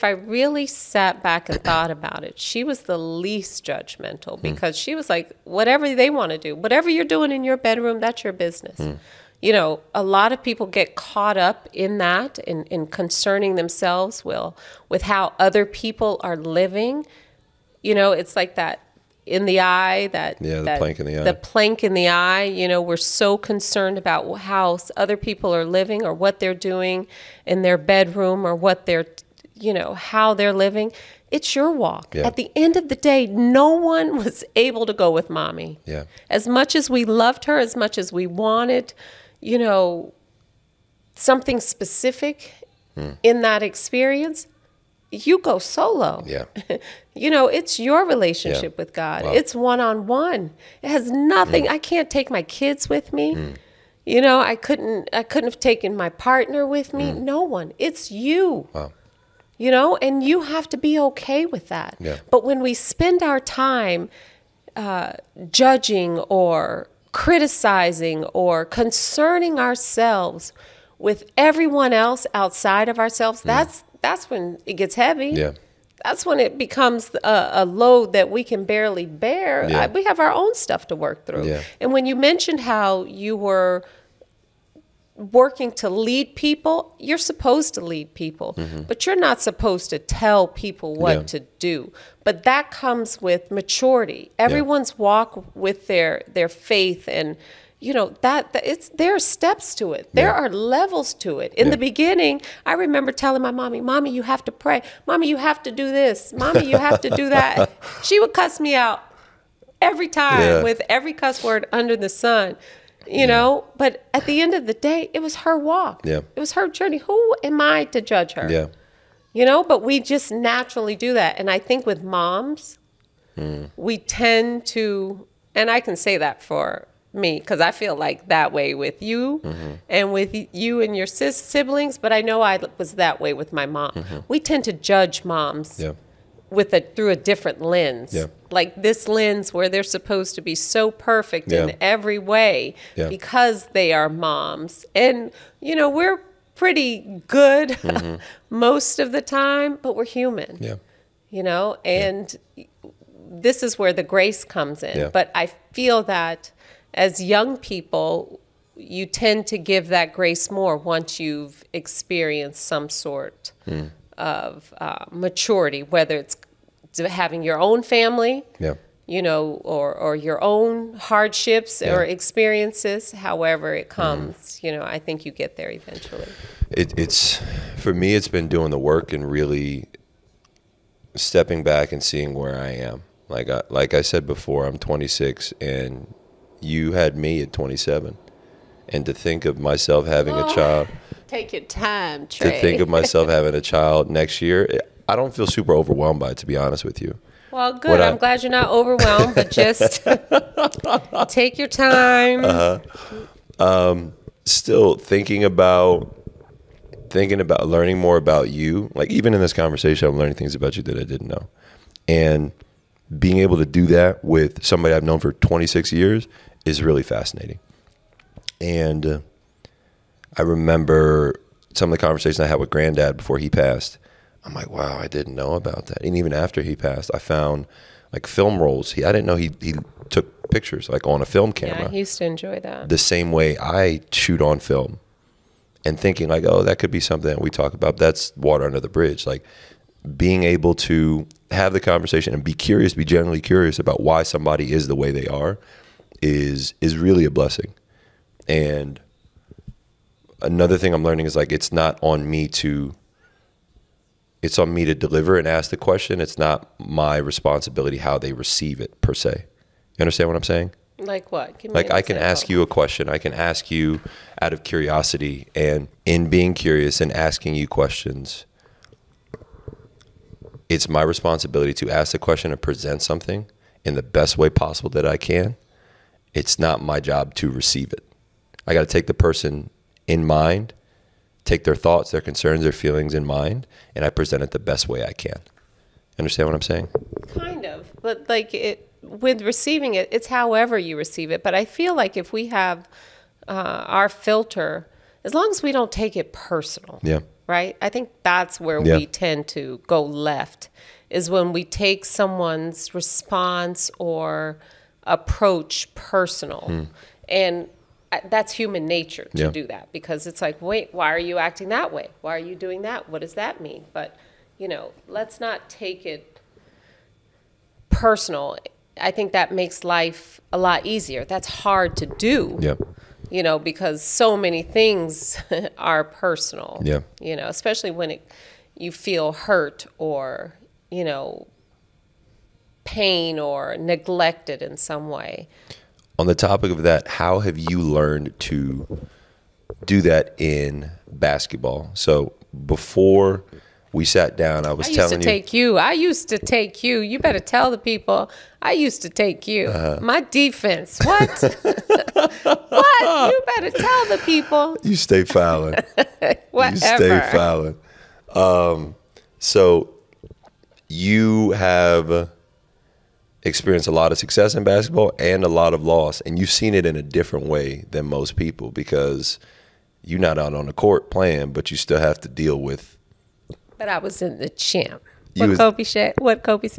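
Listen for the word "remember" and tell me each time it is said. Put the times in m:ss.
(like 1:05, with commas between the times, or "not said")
1:42, 3:40.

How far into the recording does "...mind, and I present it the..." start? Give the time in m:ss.
4:43.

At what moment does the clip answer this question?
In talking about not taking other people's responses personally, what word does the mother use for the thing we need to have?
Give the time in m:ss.
4:54.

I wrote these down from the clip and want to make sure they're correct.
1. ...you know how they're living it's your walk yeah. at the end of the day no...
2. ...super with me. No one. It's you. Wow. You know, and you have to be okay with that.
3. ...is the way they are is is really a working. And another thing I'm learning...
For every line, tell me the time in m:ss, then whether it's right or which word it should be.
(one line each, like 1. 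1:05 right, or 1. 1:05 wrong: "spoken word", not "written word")
1. 0:29 right
2. 0:56 wrong: "partner", not "super"
3. 4:04 wrong: "blessing", not "working".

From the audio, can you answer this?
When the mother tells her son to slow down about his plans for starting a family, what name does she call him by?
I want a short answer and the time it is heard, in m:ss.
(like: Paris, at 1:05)
Trey, at 3:12.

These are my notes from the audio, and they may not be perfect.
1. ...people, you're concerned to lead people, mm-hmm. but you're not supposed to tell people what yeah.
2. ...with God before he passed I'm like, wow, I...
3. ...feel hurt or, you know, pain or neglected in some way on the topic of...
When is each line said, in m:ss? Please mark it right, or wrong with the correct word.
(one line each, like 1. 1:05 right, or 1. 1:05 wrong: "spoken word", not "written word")
1. 1:26 wrong: "supposed", not "concerned"
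2. 3:42 wrong: "Granddad", not "God"
3. 5:28 right.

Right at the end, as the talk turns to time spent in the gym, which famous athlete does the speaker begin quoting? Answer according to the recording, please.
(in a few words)
Kobe.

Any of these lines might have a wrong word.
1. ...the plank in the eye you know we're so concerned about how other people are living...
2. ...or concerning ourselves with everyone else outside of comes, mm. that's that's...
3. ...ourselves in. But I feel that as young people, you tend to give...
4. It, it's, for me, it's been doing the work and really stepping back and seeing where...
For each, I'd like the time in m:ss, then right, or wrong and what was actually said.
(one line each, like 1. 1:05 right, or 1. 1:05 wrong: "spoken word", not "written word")
1. 0:21 right
2. 1:08 wrong: "ourselves", not "comes"
3. 2:34 wrong: "comes", not "ourselves"
4. 2:56 right.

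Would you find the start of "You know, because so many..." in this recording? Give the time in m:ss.
5:23.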